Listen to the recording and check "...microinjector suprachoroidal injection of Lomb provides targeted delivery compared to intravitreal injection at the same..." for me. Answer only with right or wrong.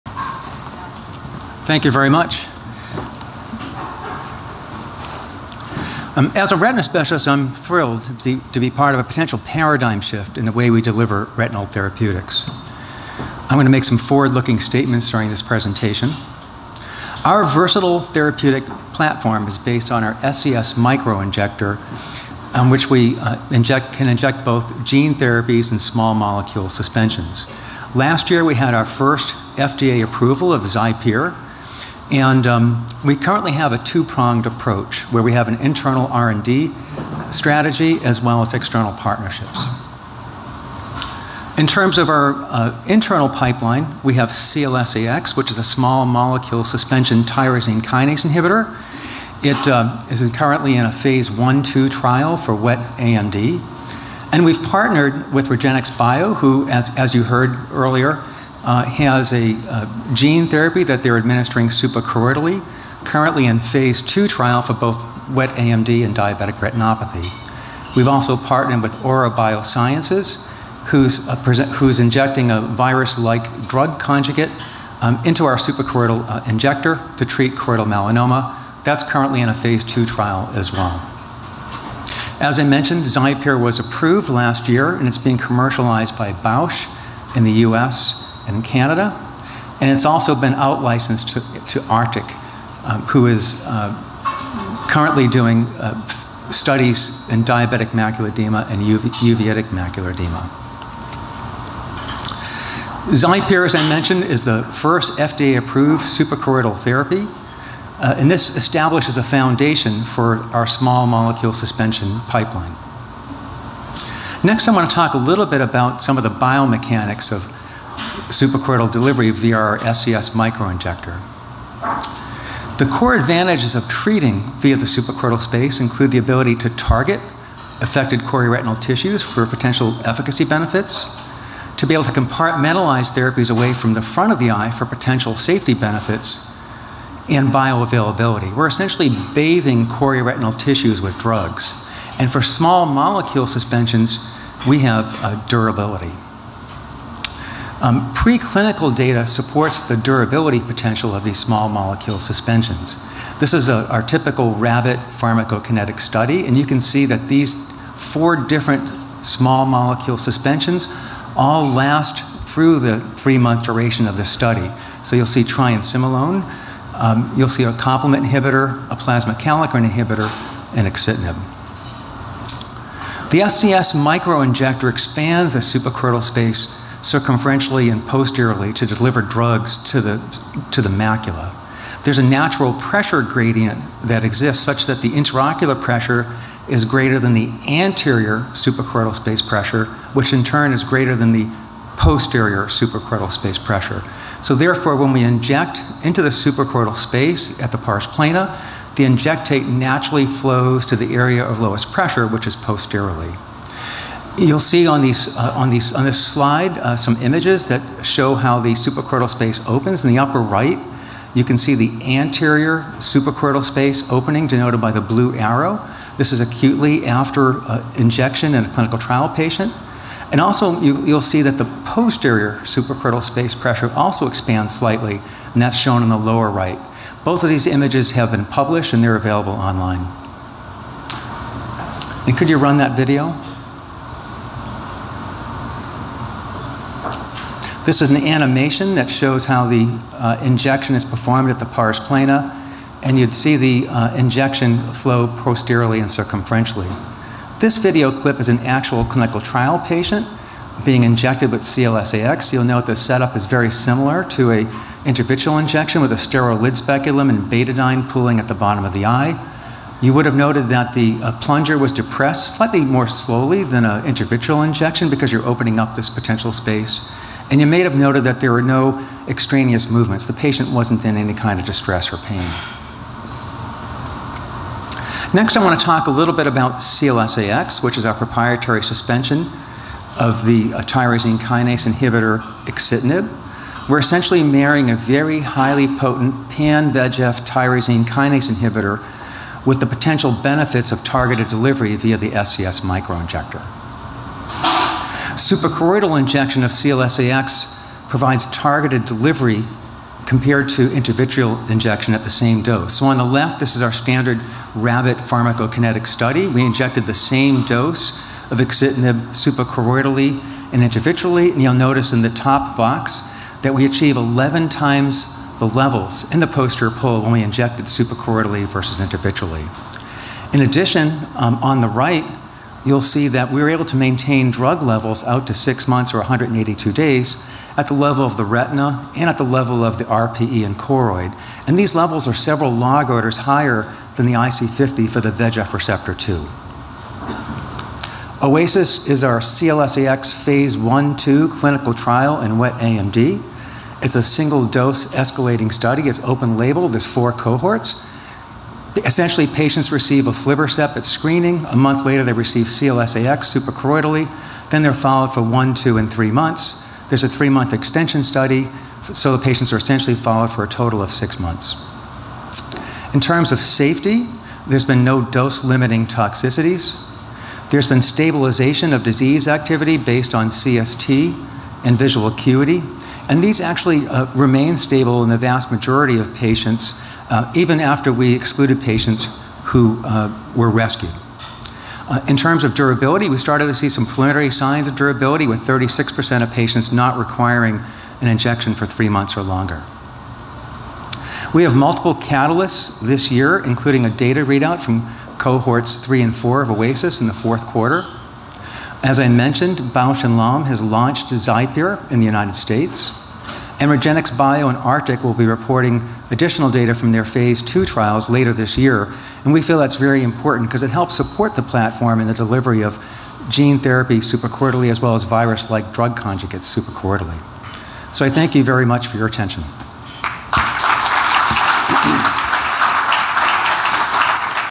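wrong.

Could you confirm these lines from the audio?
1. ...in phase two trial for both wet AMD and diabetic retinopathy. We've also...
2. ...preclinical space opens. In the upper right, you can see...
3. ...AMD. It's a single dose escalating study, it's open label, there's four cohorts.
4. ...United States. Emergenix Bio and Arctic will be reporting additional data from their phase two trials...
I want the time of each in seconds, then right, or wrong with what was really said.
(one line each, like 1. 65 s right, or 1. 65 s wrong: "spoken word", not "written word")
1. 63 s right
2. 208 s wrong: "suprachoroidal", not "preclinical"
3. 342 s right
4. 402 s right.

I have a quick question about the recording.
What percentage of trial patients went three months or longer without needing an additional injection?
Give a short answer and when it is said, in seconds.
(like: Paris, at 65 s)
36%, at 385 s.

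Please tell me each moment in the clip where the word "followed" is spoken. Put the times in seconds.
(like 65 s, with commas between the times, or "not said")
354 s, 360 s.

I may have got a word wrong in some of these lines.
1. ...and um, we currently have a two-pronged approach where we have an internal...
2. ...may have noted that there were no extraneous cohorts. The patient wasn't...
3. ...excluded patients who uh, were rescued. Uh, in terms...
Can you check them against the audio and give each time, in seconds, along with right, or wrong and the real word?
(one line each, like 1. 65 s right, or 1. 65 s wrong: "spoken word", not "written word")
1. 32 s right
2. 267 s wrong: "movements", not "cohorts"
3. 378 s right.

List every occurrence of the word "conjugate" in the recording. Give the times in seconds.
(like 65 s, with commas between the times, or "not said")
73 s, 416 s.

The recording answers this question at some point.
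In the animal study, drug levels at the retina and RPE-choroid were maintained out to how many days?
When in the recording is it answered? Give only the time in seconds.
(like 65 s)
326 s.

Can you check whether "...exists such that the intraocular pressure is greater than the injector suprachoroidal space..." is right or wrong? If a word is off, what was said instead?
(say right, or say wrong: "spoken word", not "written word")
wrong: "anterior", not "injector".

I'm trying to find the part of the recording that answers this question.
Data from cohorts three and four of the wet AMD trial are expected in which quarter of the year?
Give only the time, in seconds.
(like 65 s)
397 s.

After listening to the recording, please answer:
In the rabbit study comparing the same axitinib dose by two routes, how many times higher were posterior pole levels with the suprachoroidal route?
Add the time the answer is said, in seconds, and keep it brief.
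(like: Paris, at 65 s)
11 times, at 314 s.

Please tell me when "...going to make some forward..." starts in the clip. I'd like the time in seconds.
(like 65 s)
13 s.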